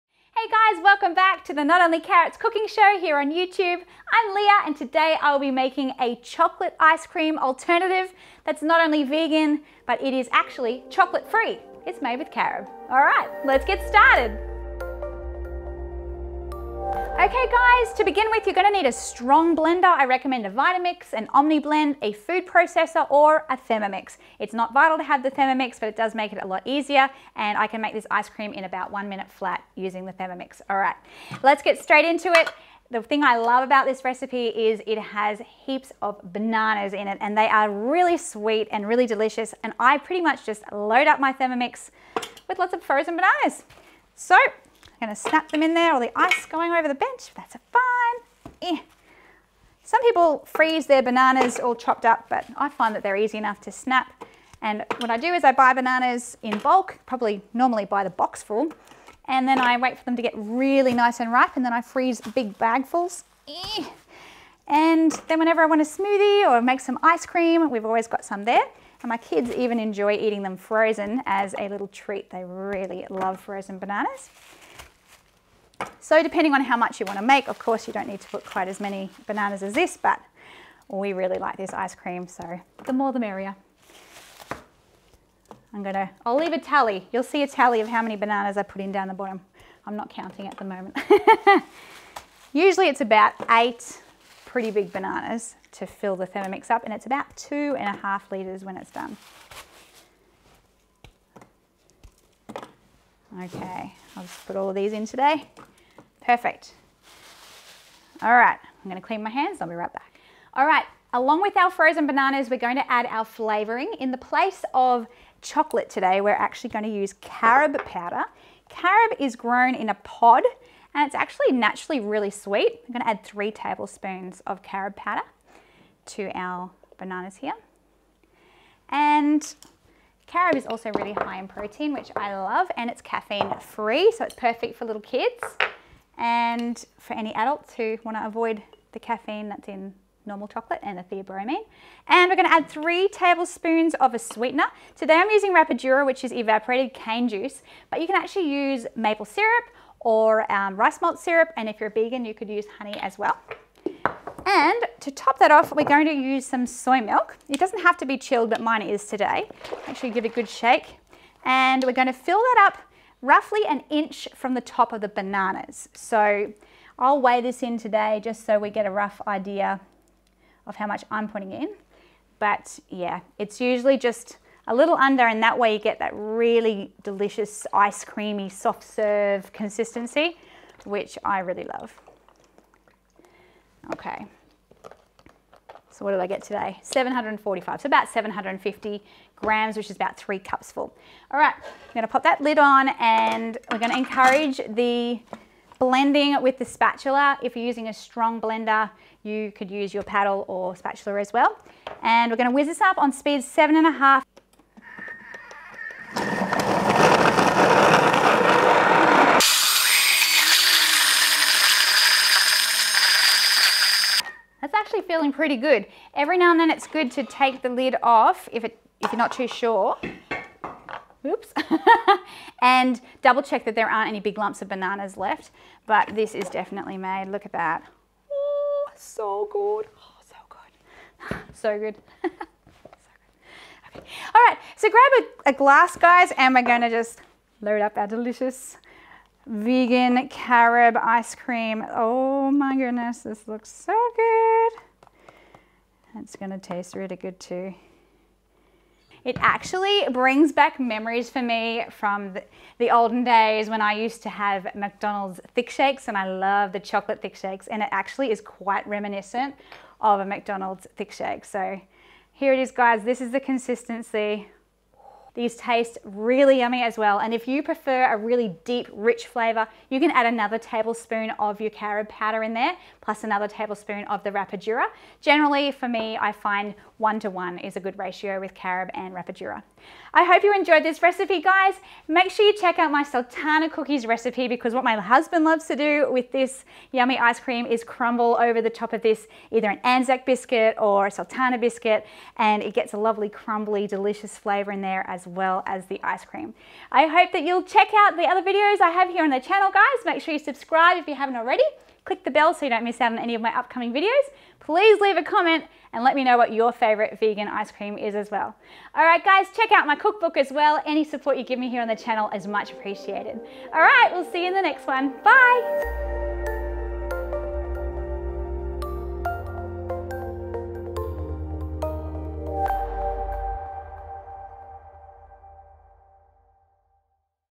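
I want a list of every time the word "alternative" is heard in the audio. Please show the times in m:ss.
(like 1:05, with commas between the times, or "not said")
0:07.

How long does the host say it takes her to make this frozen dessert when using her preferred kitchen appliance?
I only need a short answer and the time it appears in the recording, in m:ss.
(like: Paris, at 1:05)
1 minute, at 0:28.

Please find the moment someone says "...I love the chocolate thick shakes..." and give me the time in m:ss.
4:16.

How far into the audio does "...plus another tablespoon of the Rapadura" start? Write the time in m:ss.
4:32.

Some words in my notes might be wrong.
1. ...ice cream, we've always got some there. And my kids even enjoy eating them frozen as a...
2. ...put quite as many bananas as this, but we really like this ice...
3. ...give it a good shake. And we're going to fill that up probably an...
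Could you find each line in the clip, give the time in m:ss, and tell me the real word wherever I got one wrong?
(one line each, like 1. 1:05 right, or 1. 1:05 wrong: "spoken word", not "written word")
1. 1:07 right
2. 1:18 right
3. 2:40 wrong: "roughly", not "probably".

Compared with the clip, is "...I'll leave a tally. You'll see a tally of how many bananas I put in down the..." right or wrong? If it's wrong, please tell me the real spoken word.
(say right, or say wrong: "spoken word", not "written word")
right.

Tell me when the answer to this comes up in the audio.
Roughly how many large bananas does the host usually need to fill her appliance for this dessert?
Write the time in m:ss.
1:33.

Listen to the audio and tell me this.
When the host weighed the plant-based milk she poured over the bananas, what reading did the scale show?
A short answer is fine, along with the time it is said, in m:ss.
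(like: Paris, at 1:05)
745, at 3:06.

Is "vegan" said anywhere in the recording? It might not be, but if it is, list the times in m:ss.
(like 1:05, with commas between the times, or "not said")
0:09, 2:31, 3:59, 5:07.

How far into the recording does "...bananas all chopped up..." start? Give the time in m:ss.
0:51.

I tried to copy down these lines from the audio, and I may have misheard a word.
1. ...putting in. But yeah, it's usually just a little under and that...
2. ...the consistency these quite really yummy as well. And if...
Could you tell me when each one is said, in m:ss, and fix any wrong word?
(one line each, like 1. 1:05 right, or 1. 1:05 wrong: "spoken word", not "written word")
1. 2:51 right
2. 4:23 wrong: "taste", not "quite".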